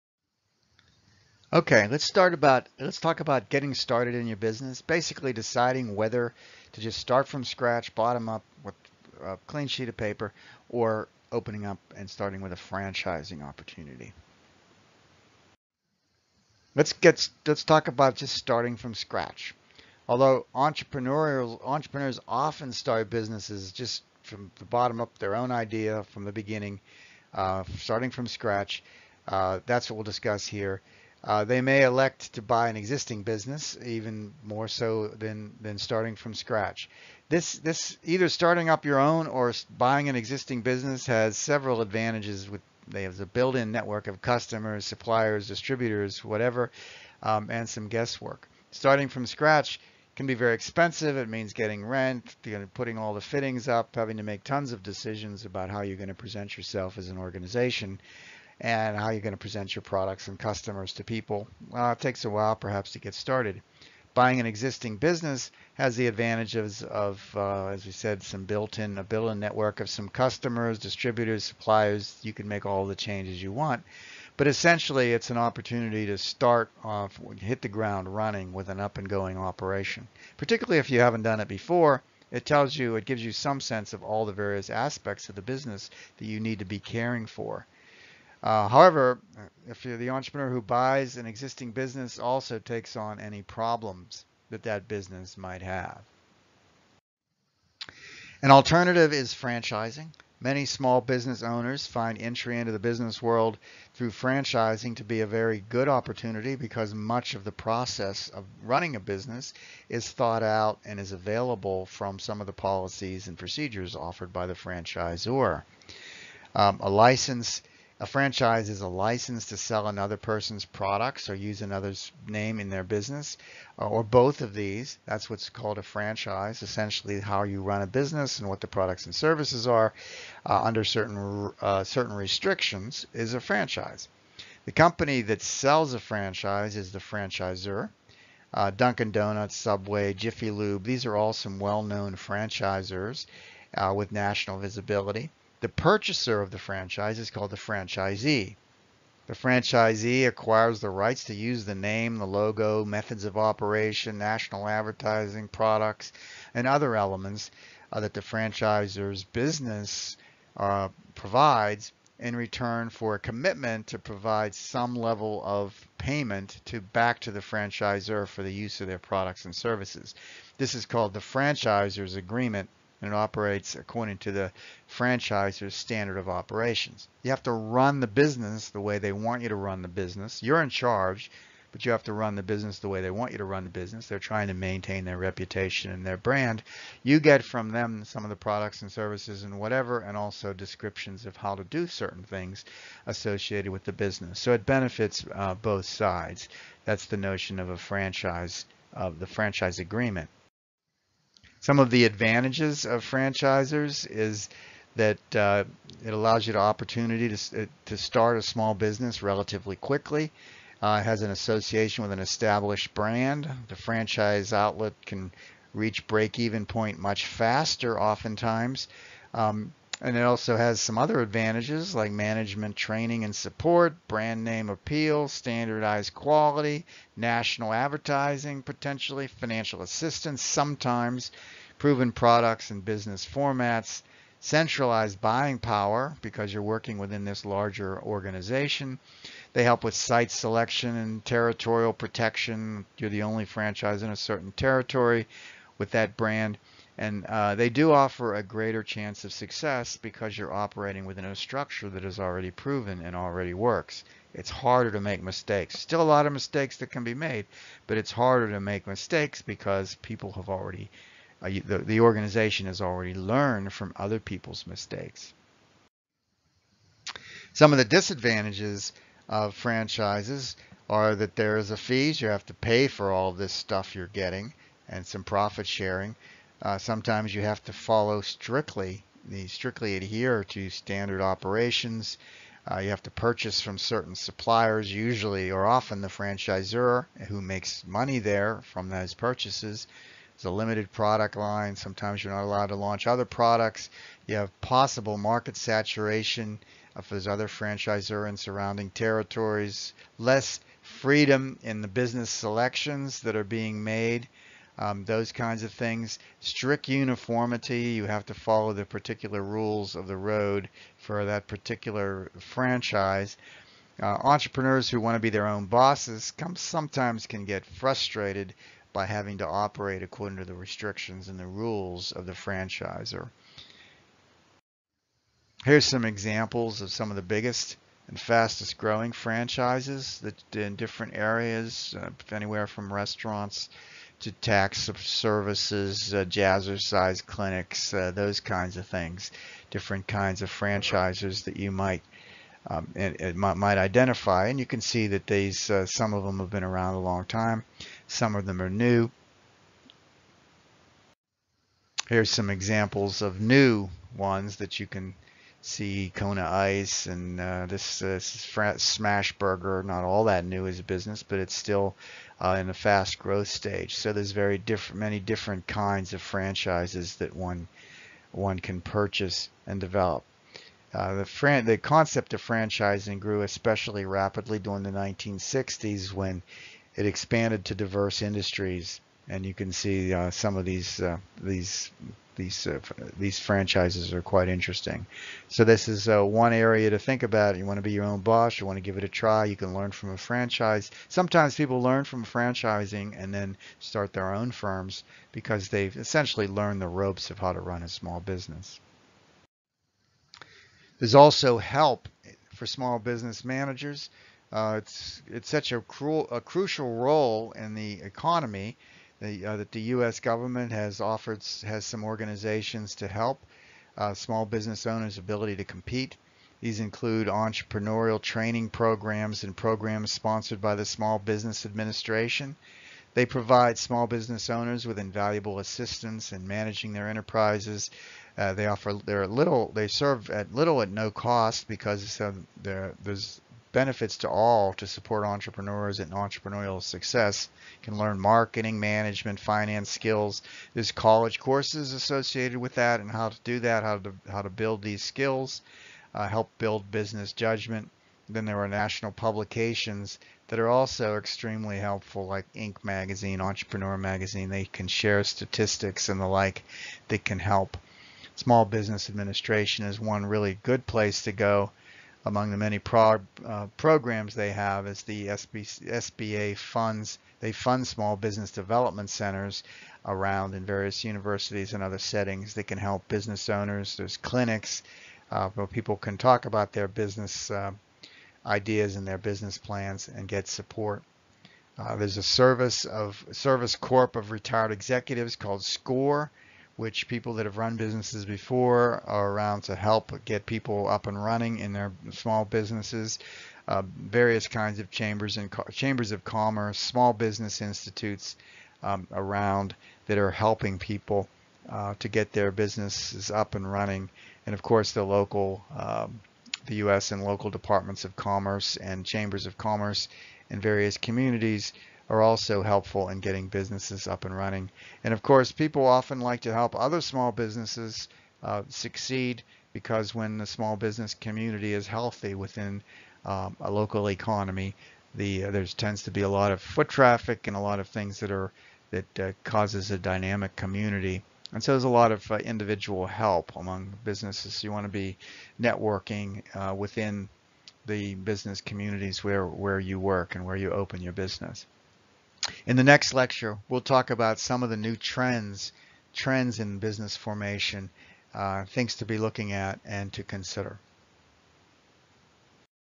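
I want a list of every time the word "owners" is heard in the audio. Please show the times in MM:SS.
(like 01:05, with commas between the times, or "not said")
01:41, 06:54, 07:04, 07:53.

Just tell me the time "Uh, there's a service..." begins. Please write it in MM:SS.
08:01.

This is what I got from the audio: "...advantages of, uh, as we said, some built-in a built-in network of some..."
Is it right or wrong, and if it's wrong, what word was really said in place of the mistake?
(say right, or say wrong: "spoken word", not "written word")
right.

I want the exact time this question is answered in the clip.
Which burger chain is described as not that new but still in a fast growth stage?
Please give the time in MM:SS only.
05:58.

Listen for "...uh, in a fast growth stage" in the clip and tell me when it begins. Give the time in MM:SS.
06:02.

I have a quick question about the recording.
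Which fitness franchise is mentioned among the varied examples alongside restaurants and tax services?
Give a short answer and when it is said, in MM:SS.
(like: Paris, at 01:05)
Jazzercise, at 05:36.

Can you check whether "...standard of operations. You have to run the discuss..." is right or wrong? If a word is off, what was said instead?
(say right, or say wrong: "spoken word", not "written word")
wrong: "business", not "discuss".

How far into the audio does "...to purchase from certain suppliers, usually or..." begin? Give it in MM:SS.
04:43.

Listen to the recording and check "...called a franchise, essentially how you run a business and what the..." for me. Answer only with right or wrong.
right.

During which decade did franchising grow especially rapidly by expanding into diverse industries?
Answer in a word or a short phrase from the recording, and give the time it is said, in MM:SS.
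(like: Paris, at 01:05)
1960s, at 06:14.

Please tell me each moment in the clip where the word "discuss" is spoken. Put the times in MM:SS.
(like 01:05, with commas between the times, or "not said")
00:30.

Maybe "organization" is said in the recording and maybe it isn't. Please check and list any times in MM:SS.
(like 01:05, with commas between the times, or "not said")
00:57, 03:58, 04:22, 06:52.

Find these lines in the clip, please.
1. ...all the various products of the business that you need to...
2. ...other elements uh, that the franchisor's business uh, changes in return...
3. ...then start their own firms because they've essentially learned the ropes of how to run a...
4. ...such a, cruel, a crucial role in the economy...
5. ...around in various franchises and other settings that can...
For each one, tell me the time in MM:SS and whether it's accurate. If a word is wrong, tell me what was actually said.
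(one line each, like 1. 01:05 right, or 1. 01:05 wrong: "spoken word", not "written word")
1. 01:24 wrong: "aspects", not "products"
2. 02:36 wrong: "provides", not "changes"
3. 06:33 right
4. 06:45 right
5. 07:50 wrong: "universities", not "franchises".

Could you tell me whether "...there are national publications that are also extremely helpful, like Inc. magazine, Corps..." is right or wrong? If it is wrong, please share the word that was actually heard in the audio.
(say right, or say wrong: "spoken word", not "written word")
wrong: "Entrepreneur", not "Corps".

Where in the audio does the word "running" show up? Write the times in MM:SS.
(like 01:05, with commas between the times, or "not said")
01:18, 01:48, 08:11, 08:23, 08:34.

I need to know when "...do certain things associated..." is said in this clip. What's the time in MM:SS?
03:11.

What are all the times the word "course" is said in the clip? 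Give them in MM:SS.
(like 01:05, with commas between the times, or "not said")
07:21, 08:24, 08:35.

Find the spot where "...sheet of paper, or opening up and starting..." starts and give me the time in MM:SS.
00:09.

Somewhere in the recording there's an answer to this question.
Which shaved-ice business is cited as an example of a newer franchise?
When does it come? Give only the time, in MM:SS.
05:56.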